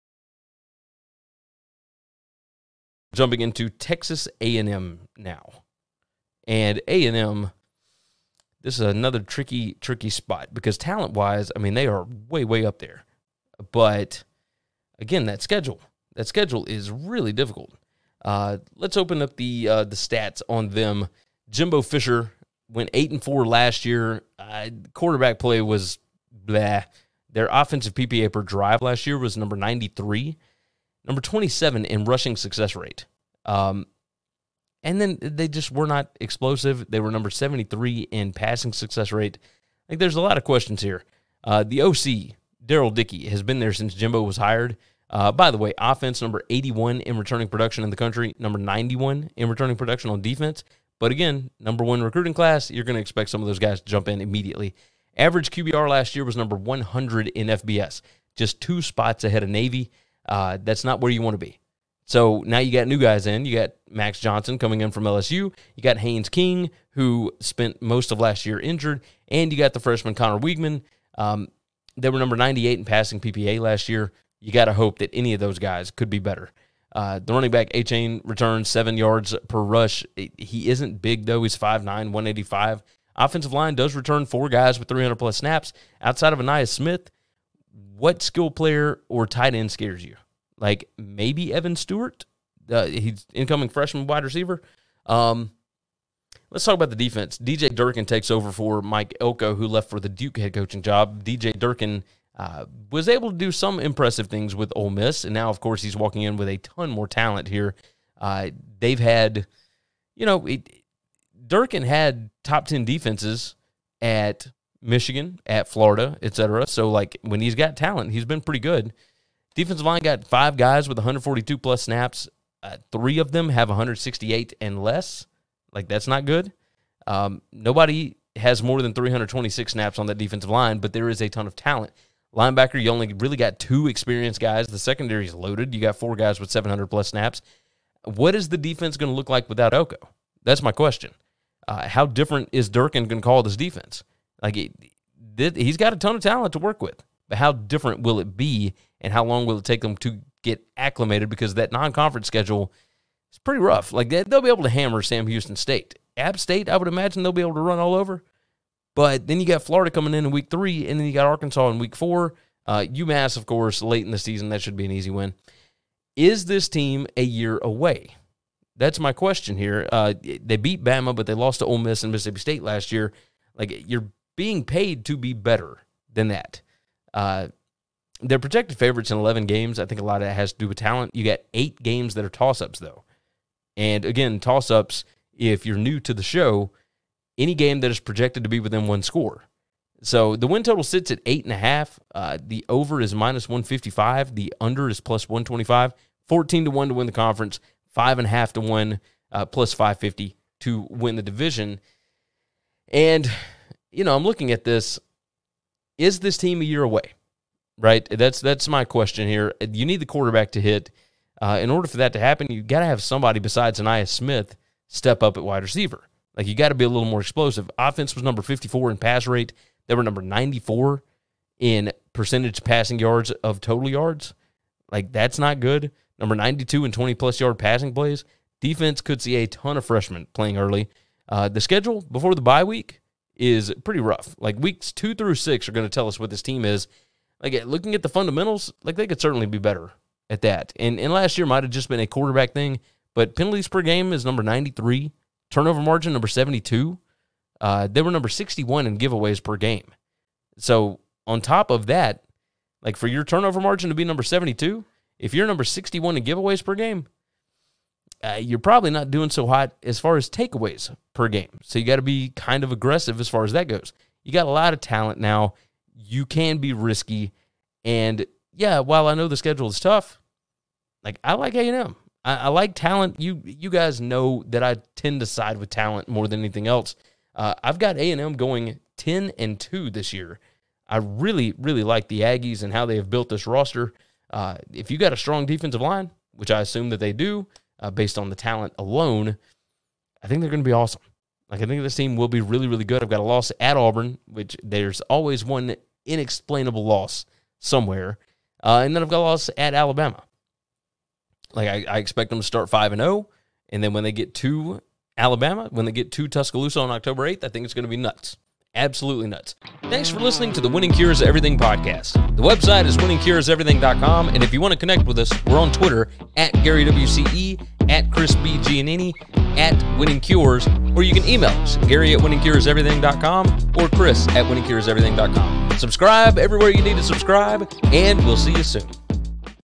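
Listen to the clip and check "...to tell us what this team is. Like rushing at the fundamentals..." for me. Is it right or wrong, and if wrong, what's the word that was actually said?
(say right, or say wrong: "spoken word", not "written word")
wrong: "looking", not "rushing".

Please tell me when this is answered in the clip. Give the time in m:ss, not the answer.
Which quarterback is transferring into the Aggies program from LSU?
1:03.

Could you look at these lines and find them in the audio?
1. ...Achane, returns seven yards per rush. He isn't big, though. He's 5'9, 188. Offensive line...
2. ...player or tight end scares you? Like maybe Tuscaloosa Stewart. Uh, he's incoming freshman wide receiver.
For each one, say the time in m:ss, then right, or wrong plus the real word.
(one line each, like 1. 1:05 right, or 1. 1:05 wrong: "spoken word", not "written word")
1. 1:17 wrong: "185", not "188"
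2. 1:28 wrong: "Evan", not "Tuscaloosa".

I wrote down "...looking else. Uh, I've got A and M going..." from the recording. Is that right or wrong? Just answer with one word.
wrong.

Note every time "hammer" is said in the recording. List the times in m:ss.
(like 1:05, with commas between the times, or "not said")
2:34.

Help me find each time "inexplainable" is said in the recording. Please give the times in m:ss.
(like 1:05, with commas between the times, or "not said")
4:56.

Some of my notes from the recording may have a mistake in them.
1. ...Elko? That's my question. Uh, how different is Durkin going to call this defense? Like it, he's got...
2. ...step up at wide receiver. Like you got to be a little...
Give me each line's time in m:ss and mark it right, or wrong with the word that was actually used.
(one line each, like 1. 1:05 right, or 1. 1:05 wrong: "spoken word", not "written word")
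1. 2:19 right
2. 3:34 right.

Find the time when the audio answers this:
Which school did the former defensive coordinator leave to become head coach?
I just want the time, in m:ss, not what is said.
1:40.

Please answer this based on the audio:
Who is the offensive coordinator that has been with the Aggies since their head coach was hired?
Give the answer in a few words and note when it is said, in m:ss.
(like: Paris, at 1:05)
Darrell Dickey, at 0:42.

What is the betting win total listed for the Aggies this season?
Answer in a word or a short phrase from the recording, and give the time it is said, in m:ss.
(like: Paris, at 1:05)
8.5, at 3:11.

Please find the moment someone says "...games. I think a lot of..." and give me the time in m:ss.
2:59.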